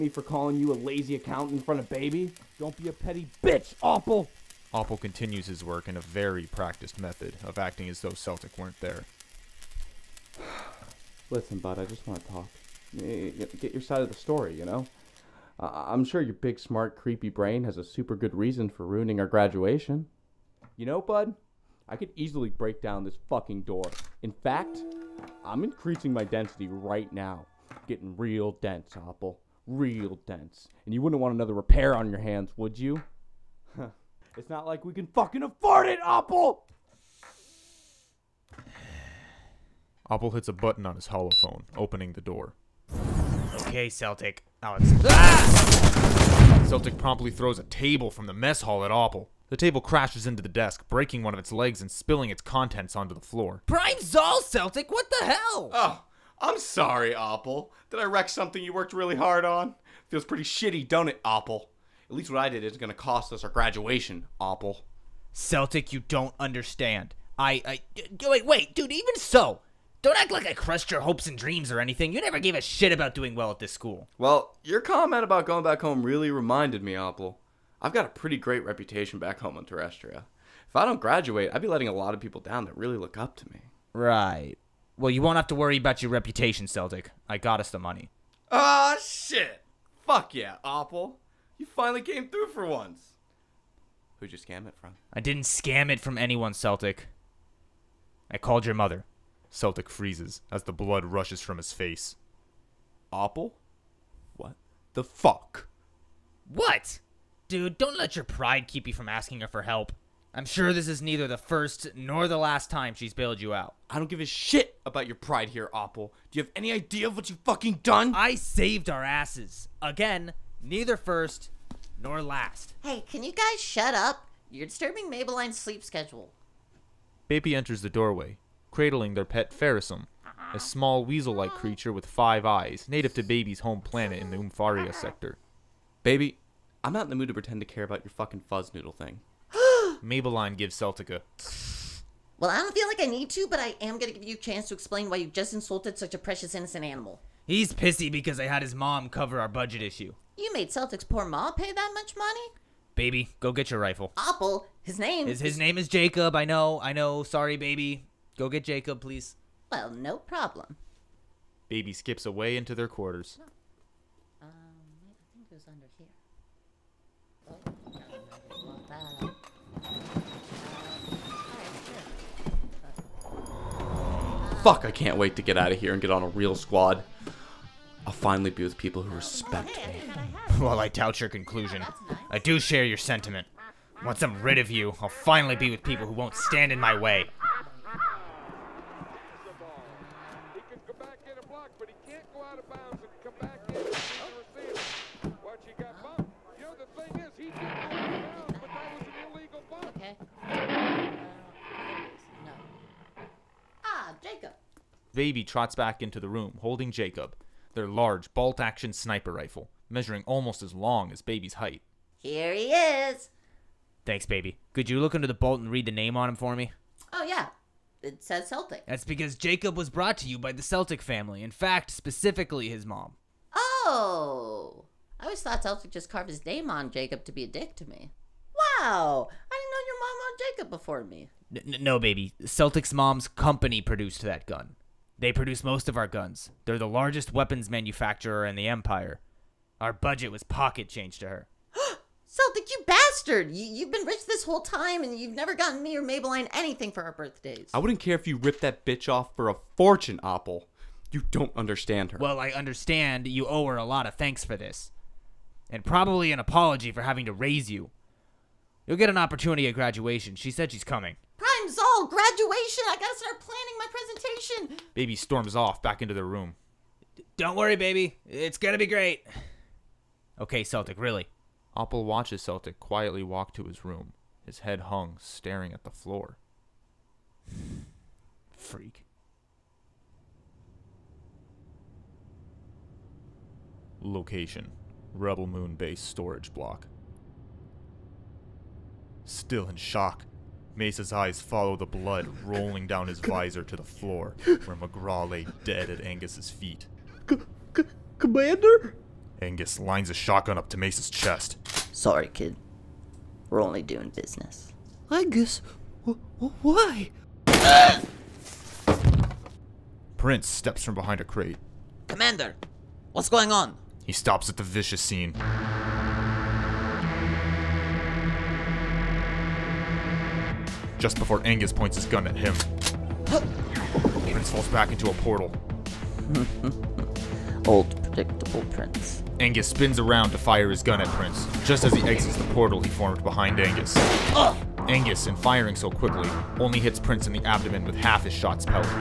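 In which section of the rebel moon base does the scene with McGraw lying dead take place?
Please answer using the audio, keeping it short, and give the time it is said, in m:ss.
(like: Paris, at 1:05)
Storage Block, at 4:46.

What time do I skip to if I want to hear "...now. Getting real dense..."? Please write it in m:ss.
0:27.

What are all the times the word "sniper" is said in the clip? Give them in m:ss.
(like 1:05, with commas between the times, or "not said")
3:28.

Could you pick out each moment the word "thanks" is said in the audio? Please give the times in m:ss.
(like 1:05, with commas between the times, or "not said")
3:34, 4:14.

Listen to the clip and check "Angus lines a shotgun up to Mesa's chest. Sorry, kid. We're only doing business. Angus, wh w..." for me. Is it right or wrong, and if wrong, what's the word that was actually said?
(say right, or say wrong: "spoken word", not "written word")
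right.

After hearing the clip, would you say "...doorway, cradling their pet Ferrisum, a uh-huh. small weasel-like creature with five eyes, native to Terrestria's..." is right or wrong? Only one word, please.
wrong.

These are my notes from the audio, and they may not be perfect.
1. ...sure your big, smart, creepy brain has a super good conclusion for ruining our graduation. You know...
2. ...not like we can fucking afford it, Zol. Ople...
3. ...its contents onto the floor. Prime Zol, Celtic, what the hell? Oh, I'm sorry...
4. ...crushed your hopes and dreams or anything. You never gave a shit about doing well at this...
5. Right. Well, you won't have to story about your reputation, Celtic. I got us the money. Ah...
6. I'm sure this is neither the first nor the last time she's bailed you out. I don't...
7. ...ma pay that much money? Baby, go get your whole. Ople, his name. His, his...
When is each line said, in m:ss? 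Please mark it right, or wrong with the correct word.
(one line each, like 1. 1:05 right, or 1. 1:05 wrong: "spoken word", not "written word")
1. 0:16 wrong: "reason", not "conclusion"
2. 0:34 wrong: "Ople", not "Zol"
3. 0:52 right
4. 1:10 right
5. 1:23 wrong: "worry", not "story"
6. 1:50 right
7. 2:31 wrong: "rifle", not "whole".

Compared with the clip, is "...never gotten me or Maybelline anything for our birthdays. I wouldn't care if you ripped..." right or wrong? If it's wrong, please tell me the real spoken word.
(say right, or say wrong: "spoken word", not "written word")
right.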